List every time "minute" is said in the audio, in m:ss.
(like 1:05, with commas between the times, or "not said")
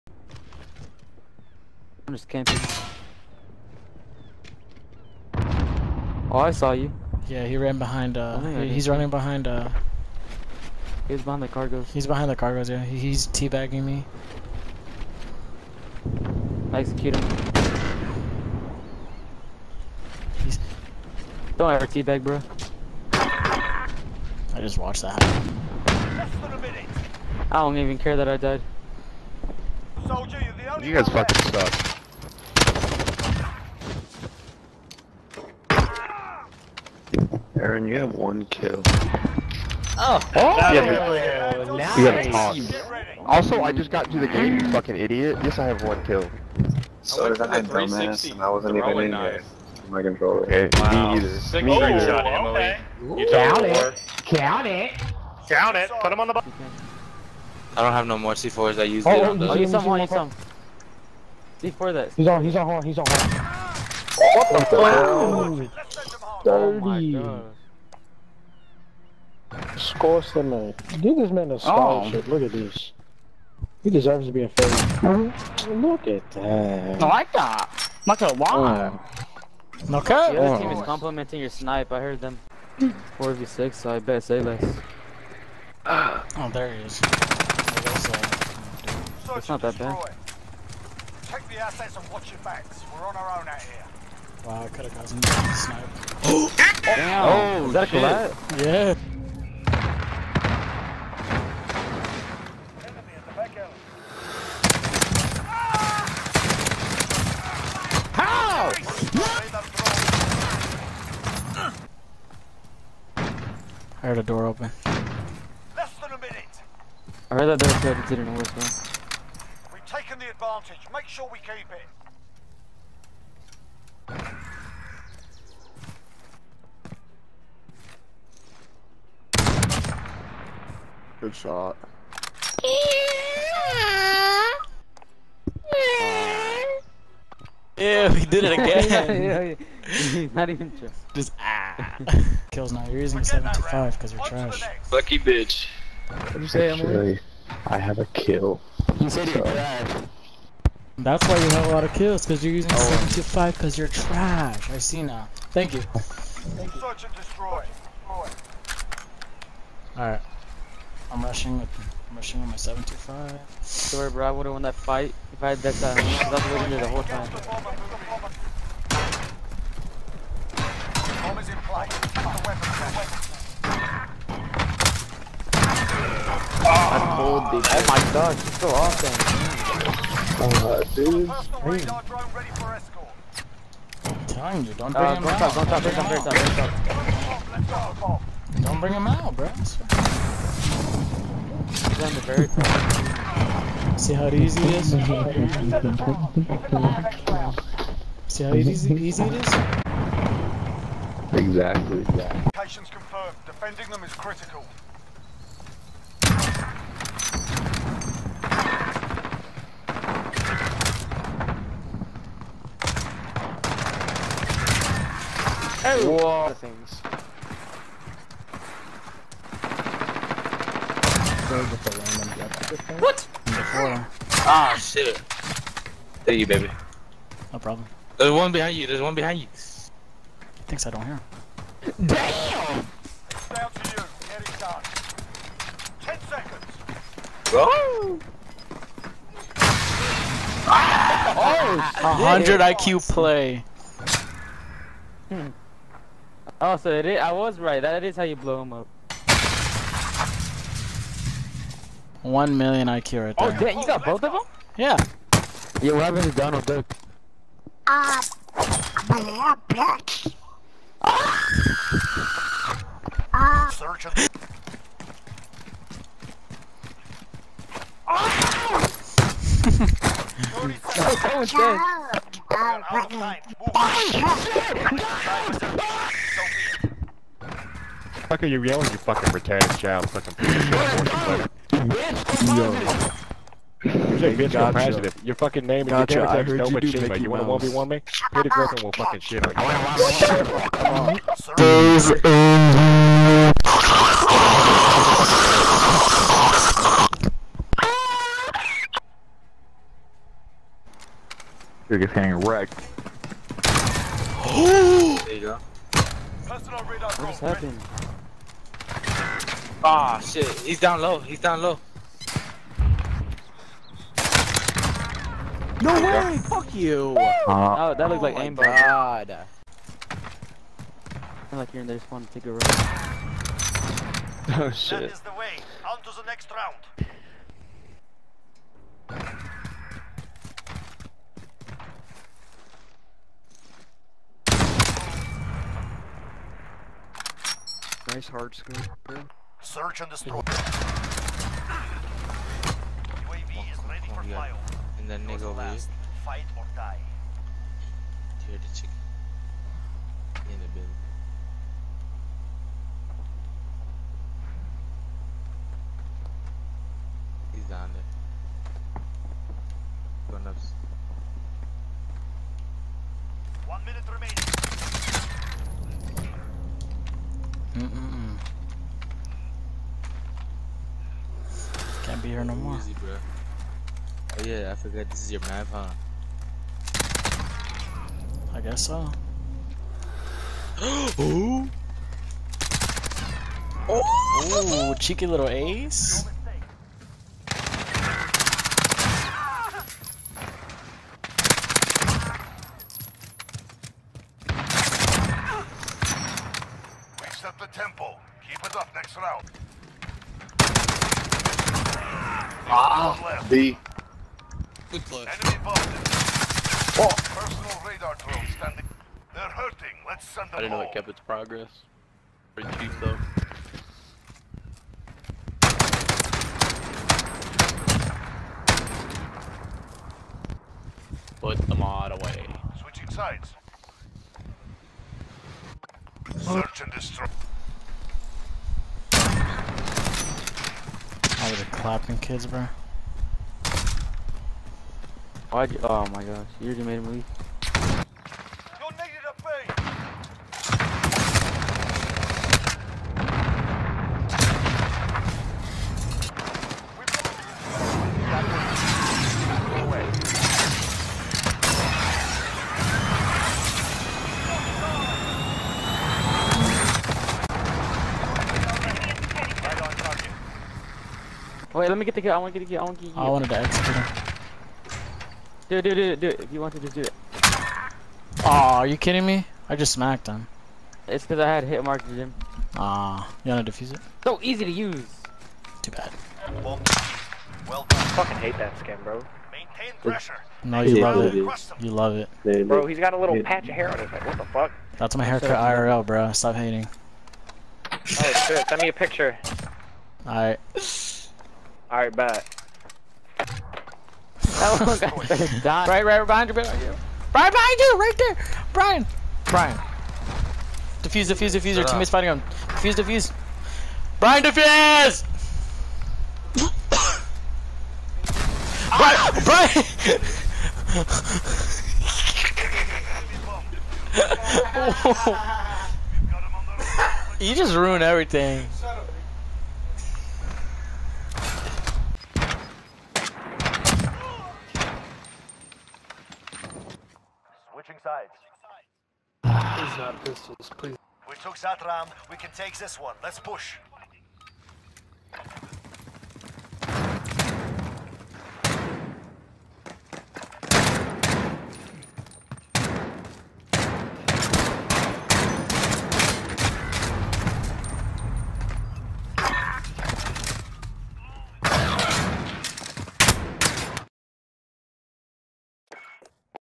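1:56, 6:03.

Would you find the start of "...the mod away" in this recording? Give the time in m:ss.
7:01.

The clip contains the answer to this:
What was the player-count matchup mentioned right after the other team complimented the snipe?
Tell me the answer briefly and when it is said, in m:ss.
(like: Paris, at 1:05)
4v6, at 1:23.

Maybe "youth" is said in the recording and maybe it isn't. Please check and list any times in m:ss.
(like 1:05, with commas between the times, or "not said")
not said.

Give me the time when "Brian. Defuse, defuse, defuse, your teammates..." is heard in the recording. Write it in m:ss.
8:19.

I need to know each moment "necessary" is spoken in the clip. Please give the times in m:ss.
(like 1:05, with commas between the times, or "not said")
not said.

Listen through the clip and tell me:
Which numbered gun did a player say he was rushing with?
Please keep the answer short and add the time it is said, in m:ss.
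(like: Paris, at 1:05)
725, at 2:42.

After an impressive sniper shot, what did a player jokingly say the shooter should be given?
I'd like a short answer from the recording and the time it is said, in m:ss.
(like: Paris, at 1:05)
A scholarship, at 1:11.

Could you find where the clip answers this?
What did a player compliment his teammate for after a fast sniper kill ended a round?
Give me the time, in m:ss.
5:38.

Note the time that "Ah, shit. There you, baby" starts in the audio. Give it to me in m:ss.
3:43.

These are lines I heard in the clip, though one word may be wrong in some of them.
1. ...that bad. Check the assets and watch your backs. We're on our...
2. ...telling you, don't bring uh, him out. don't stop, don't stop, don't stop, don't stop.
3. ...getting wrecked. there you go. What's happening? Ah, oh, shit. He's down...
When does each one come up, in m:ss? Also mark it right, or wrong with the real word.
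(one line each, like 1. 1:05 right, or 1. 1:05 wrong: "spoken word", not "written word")
1. 1:29 right
2. 3:04 right
3. 5:01 right.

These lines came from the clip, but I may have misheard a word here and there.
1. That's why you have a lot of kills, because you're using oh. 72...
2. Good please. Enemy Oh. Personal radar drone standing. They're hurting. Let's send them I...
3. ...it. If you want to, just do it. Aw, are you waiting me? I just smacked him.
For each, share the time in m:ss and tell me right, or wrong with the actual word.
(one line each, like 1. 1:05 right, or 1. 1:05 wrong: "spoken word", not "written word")
1. 2:30 wrong: "75", not "72"
2. 6:44 wrong: "close", not "please"
3. 7:46 wrong: "kidding", not "waiting".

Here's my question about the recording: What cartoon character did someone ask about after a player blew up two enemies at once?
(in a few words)
Donald Duck.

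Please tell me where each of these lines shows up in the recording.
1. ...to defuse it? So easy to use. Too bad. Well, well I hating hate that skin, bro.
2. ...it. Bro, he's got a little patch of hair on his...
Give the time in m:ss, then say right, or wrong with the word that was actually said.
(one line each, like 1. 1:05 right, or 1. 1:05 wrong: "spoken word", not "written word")
1. 7:53 wrong: "fucking", not "hating"
2. 8:02 right.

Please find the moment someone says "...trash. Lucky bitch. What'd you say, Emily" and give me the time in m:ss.
2:24.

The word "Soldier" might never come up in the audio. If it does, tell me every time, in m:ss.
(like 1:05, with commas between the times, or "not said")
0:30.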